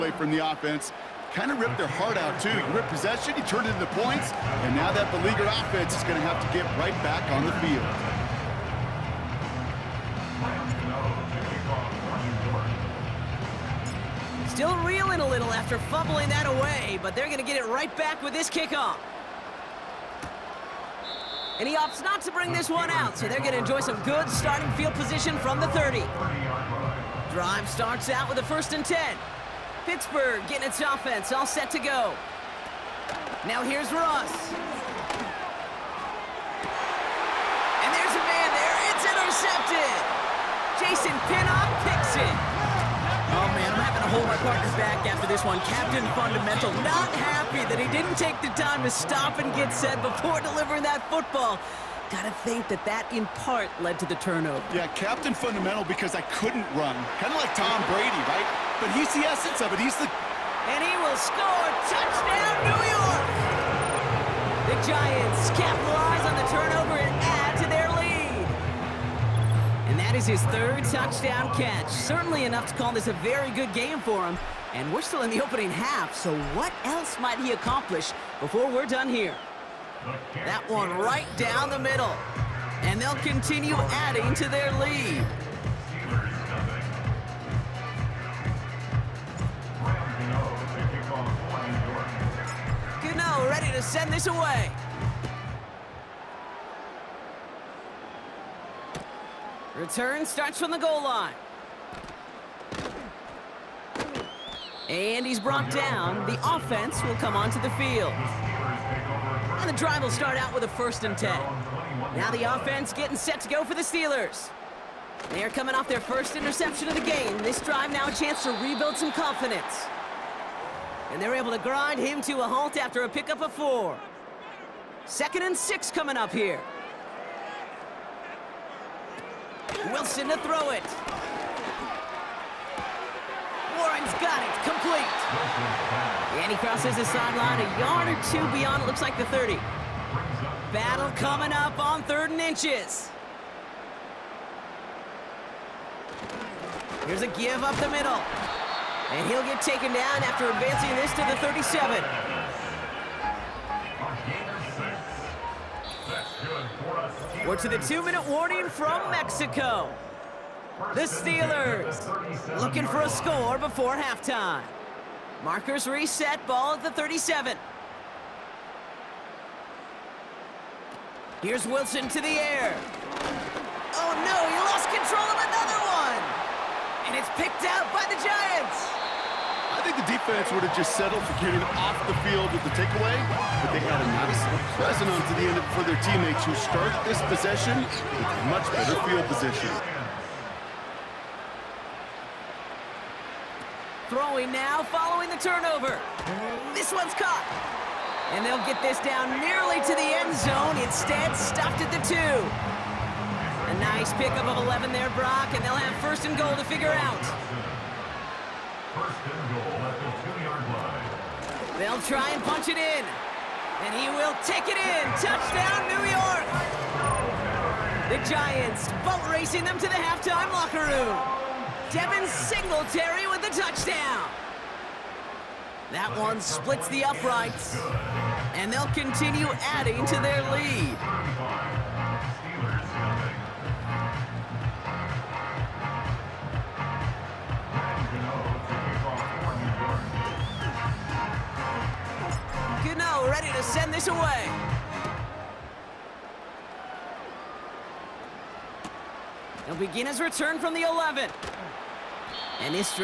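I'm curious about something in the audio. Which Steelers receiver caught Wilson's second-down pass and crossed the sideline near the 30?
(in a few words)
Warren.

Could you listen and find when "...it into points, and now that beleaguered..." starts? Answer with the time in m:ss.
0:03.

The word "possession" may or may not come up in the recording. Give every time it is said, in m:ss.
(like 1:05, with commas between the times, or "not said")
0:02, 3:07.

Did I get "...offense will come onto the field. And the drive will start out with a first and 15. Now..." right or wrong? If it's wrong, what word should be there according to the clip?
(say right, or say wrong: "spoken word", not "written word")
wrong: "10", not "15".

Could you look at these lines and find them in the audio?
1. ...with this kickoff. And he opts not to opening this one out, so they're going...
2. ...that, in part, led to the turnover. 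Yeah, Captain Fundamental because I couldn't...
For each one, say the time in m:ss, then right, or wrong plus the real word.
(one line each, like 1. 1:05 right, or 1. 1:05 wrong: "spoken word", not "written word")
1. 0:18 wrong: "bring", not "opening"
2. 0:52 right.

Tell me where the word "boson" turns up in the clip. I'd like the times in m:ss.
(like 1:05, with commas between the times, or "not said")
not said.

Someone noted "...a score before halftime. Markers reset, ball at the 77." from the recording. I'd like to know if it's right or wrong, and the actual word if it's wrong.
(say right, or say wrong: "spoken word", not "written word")
wrong: "37", not "77".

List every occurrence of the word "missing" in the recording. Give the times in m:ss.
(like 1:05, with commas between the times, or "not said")
not said.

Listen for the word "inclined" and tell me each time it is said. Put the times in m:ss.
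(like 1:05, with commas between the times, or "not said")
not said.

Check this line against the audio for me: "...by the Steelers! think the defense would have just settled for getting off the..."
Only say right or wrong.
wrong.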